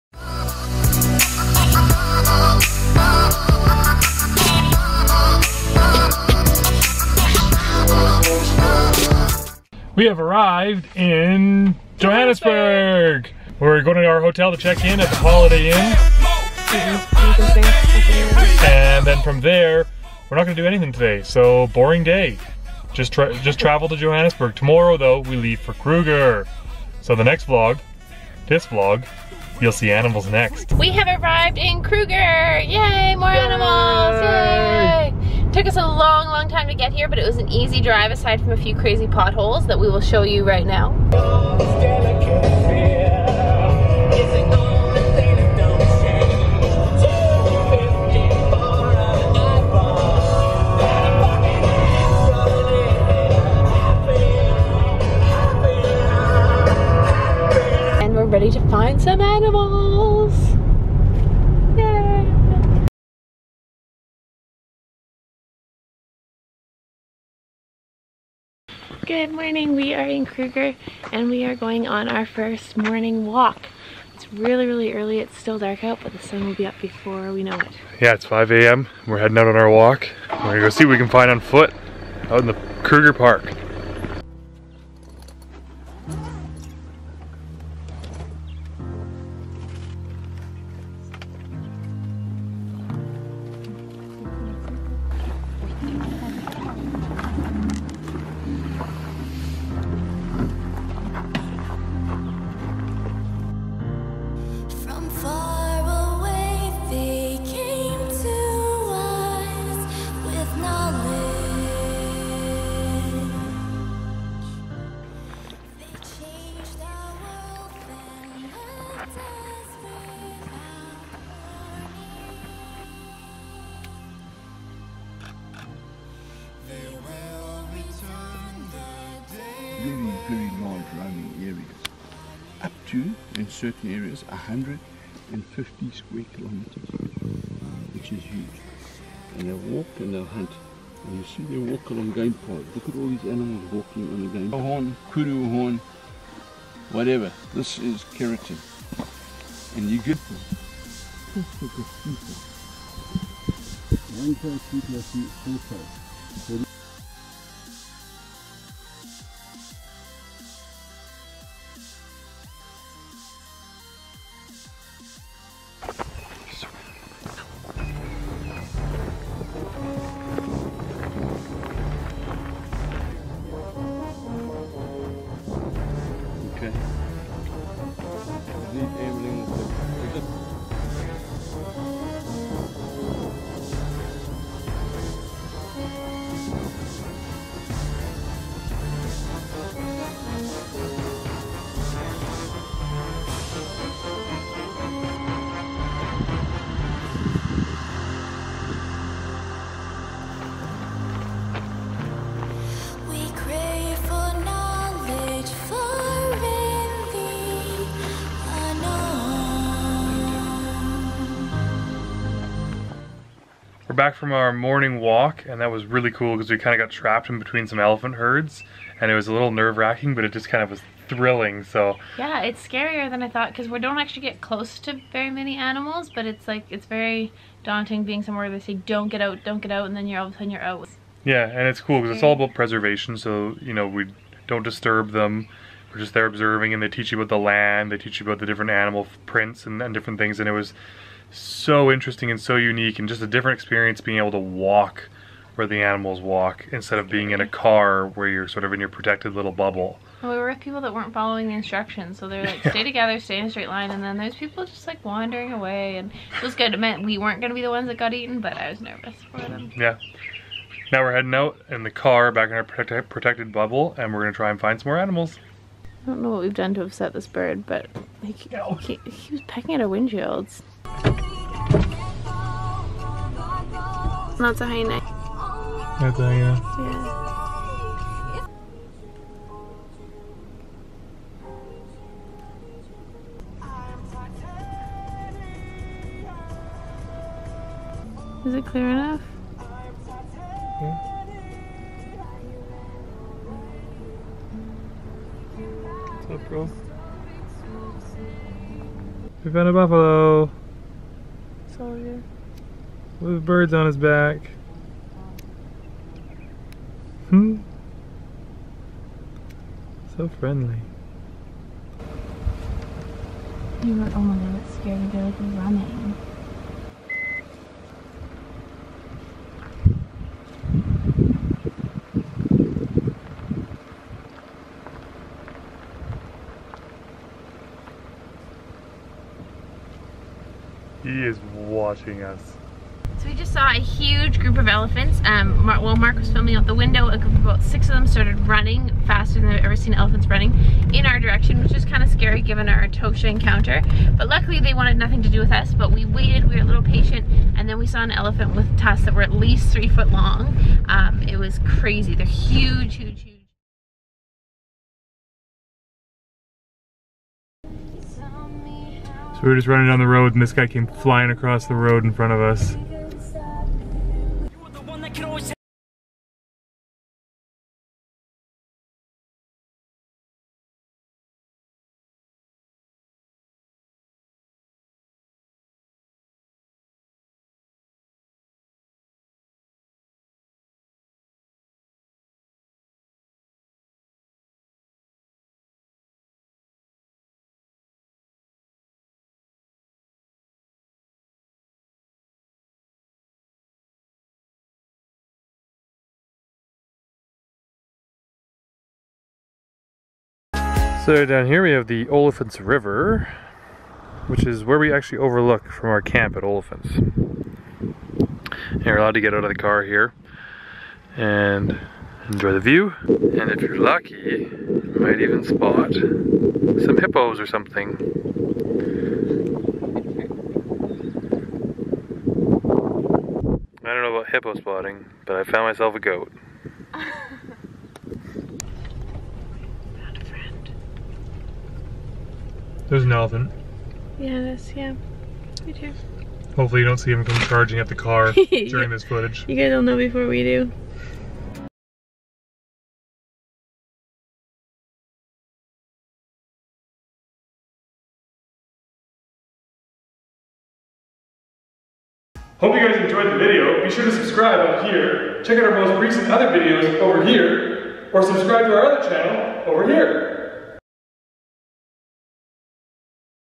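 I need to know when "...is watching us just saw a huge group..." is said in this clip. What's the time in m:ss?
5:31.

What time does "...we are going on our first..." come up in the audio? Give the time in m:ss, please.
1:11.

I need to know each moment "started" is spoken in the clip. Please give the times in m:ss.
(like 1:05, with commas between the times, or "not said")
5:38.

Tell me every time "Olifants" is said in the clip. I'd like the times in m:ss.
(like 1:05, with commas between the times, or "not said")
6:42, 6:46.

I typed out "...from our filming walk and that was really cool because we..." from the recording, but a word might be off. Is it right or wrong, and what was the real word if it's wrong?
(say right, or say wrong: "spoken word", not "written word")
wrong: "morning", not "filming".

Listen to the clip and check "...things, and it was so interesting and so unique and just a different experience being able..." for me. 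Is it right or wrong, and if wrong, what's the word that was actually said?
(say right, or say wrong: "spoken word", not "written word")
right.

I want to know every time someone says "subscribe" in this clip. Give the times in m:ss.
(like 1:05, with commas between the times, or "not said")
7:34, 7:38.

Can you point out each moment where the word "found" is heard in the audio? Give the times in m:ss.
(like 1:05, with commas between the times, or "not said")
4:59, 7:05.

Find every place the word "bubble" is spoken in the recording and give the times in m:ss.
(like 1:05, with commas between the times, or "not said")
4:09, 4:23.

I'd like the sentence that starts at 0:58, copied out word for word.
And we're ready to find some animals.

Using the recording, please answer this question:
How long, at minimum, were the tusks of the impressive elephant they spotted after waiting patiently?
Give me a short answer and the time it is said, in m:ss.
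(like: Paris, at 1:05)
3 feet, at 5:49.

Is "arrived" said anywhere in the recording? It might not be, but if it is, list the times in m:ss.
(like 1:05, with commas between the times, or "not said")
0:10, 0:31.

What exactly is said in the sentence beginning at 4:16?
It meant we weren't going to be the ones that got eaten, but I was nervous for them.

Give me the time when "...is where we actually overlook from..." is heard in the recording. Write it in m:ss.
6:44.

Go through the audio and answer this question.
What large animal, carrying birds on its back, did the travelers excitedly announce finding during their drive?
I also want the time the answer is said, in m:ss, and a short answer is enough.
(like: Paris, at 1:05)
Buffalo, at 4:59.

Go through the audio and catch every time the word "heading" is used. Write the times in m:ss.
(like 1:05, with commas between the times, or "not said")
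1:19, 4:21.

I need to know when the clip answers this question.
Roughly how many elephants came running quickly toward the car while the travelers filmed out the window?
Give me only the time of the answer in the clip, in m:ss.
5:37.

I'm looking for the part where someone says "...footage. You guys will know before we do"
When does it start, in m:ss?
7:19.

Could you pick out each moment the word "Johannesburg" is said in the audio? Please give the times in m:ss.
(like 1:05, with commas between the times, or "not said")
0:11, 0:23.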